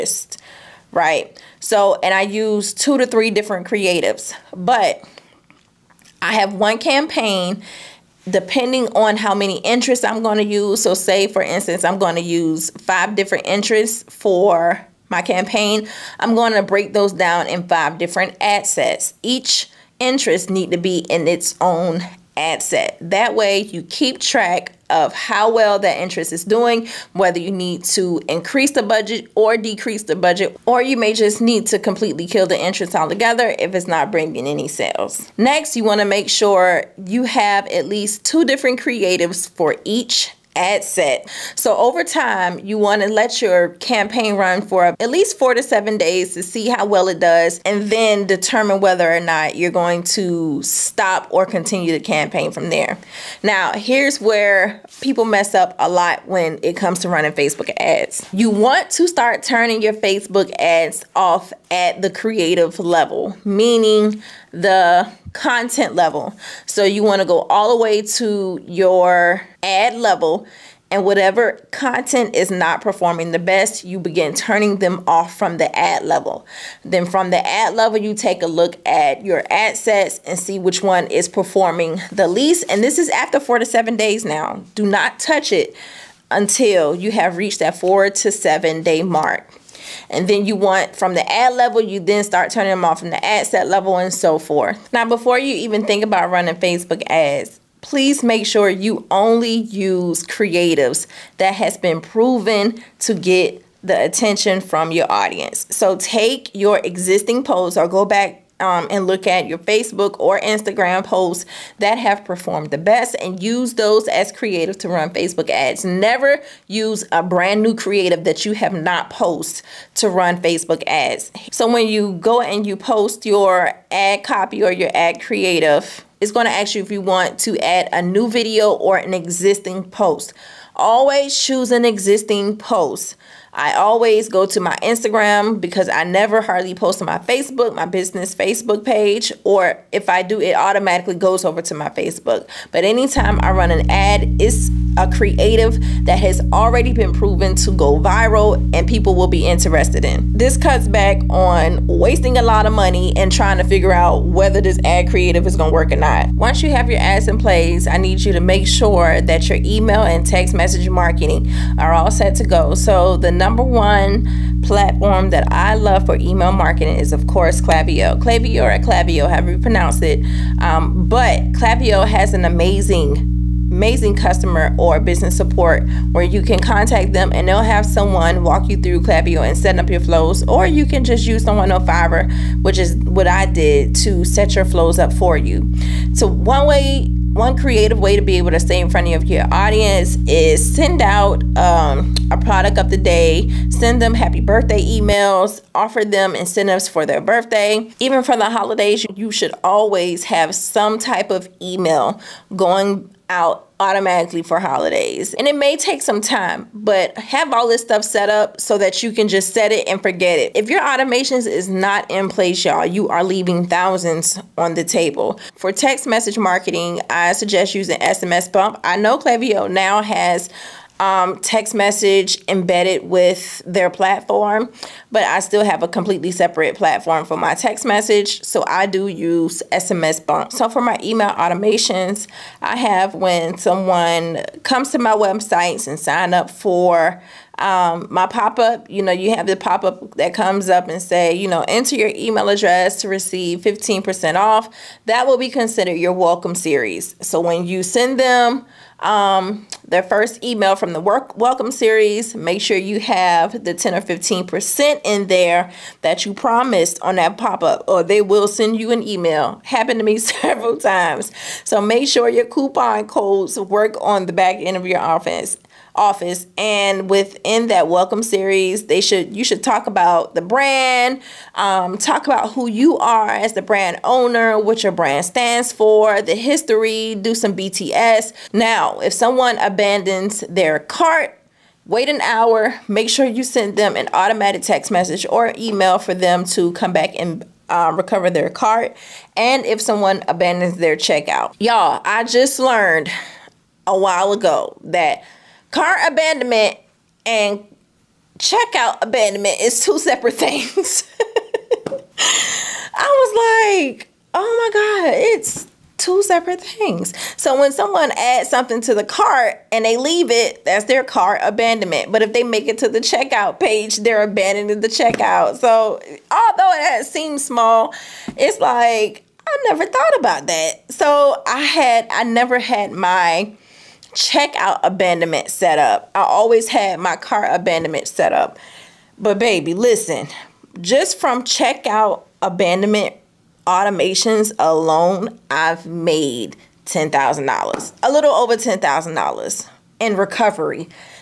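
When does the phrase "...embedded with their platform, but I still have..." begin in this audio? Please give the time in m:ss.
3:42.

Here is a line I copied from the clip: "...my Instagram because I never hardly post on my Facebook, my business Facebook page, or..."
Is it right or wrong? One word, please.
right.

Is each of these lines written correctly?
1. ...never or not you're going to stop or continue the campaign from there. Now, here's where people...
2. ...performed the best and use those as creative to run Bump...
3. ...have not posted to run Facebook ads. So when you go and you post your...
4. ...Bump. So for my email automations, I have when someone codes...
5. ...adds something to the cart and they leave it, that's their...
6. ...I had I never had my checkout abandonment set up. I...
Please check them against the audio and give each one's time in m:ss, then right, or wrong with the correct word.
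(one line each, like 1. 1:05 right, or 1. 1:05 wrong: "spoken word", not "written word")
1. 0:48 wrong: "whether", not "never"
2. 1:52 wrong: "Facebook", not "Bump"
3. 1:58 right
4. 3:50 wrong: "comes", not "codes"
5. 5:08 right
6. 5:21 right.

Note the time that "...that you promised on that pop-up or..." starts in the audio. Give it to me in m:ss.
4:16.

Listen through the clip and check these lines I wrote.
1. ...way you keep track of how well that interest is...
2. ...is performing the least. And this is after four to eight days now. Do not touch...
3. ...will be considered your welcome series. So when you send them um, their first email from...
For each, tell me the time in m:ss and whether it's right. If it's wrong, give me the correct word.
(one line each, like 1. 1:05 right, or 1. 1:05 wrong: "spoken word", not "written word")
1. 0:23 right
2. 1:21 wrong: "seven", not "eight"
3. 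4:05 right.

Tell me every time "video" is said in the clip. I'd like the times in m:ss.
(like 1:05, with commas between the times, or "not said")
2:08.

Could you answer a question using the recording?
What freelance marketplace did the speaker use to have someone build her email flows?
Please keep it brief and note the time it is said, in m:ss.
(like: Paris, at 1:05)
Fiverr, at 3:01.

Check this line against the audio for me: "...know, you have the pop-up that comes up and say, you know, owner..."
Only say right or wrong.
wrong.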